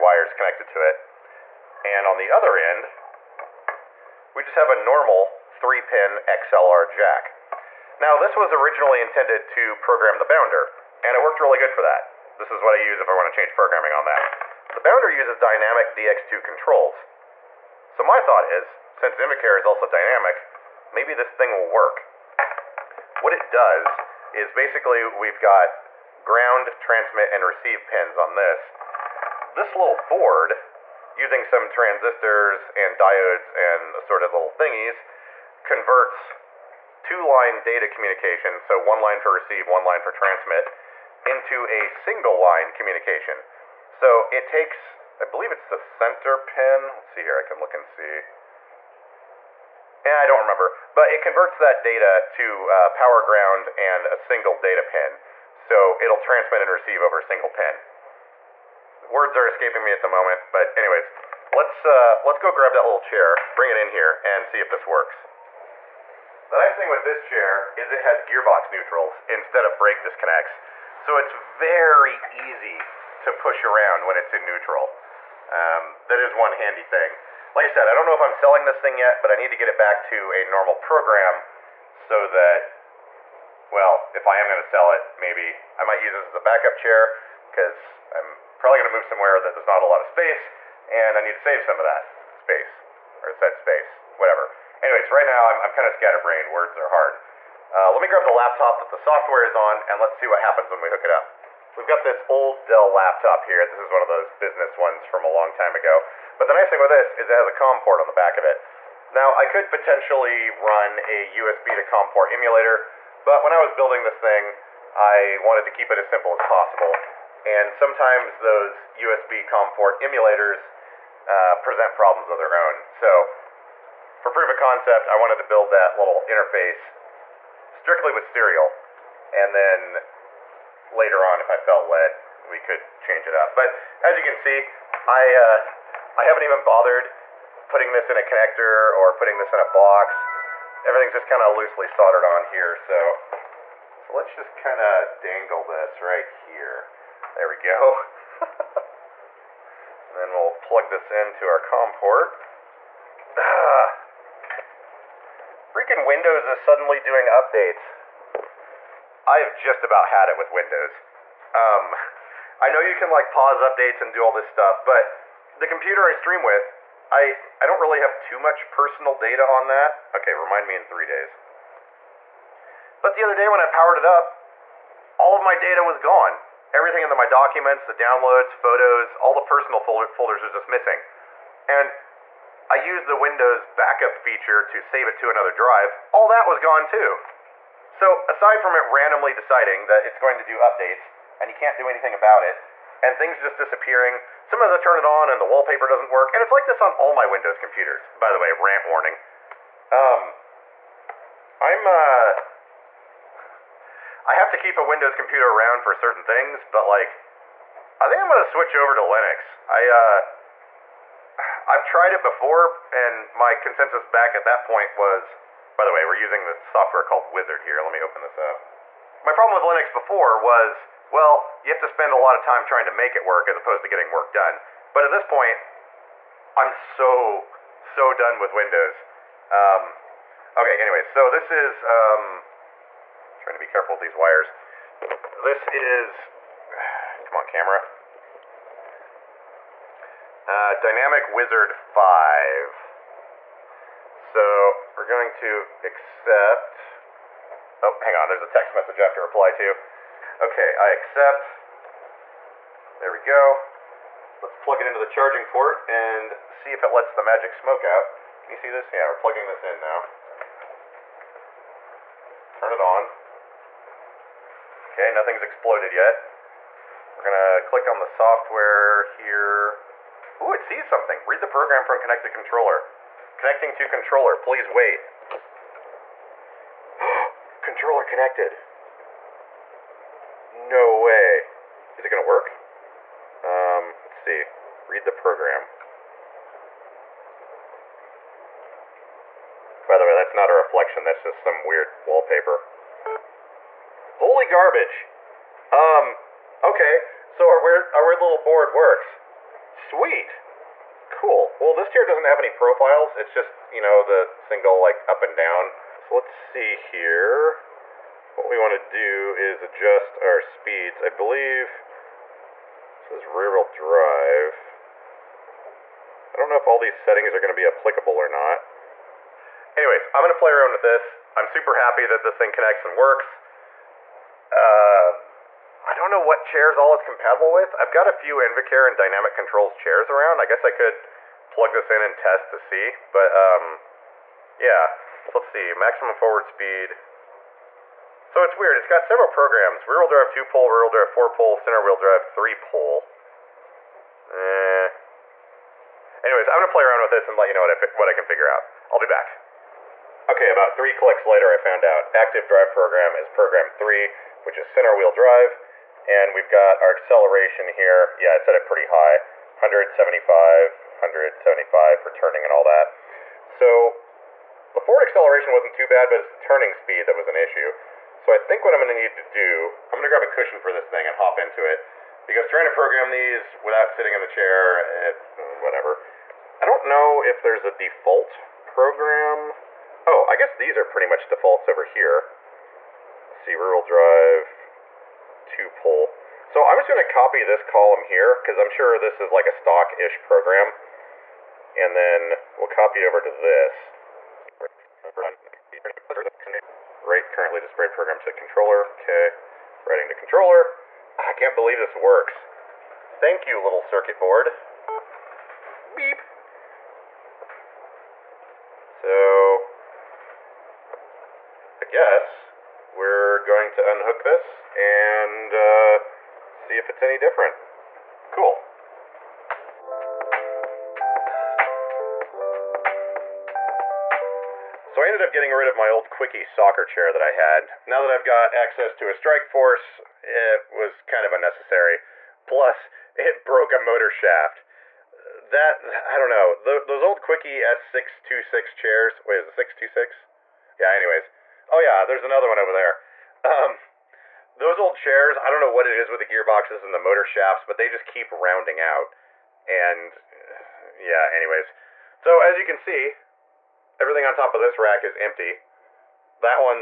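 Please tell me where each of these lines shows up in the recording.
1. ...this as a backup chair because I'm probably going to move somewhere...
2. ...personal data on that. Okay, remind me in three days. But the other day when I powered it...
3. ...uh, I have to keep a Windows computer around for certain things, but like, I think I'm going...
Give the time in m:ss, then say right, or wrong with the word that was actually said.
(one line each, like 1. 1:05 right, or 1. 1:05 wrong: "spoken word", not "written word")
1. 1:26 right
2. 2:48 right
3. 3:21 right.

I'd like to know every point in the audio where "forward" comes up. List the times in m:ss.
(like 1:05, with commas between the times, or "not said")
5:36, 6:04.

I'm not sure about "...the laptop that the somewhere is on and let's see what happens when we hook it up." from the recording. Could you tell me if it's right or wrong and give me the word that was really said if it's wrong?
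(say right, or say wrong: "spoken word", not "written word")
wrong: "software", not "somewhere".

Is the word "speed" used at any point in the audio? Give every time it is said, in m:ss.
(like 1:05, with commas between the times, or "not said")
5:10, 5:36, 6:06.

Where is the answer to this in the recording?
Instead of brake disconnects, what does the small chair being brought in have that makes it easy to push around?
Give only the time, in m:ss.
1:08.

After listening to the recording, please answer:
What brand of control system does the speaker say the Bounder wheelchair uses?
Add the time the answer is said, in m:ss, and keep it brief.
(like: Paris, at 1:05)
Dynamic DX2, at 0:15.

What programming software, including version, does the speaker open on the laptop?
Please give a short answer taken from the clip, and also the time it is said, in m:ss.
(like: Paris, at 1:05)
Dynamic Wizard 5, at 4:00.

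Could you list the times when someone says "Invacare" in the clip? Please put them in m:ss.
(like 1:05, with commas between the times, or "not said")
0:19, 5:28.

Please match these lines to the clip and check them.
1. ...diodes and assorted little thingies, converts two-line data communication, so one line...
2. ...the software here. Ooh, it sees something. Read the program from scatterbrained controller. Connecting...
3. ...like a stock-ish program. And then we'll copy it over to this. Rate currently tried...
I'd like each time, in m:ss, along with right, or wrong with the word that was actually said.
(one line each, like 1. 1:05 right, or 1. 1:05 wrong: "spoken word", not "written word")
1. 0:32 right
2. 4:27 wrong: "connected", not "scatterbrained"
3. 6:29 wrong: "displayed", not "tried".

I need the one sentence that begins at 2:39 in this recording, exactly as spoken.
I have just about had it with Windows.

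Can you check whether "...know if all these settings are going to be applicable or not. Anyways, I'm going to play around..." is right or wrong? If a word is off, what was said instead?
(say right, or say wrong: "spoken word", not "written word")
right.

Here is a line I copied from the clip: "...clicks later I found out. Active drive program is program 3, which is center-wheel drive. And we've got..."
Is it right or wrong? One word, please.
right.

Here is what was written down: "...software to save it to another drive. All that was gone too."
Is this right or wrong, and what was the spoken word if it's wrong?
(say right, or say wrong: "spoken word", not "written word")
wrong: "feature", not "software".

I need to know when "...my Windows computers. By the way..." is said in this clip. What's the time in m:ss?
3:17.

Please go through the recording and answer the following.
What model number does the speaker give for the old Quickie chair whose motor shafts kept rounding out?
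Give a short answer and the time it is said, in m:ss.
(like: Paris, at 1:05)
S626, at 7:17.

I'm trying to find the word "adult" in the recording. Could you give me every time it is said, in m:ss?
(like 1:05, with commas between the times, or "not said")
not said.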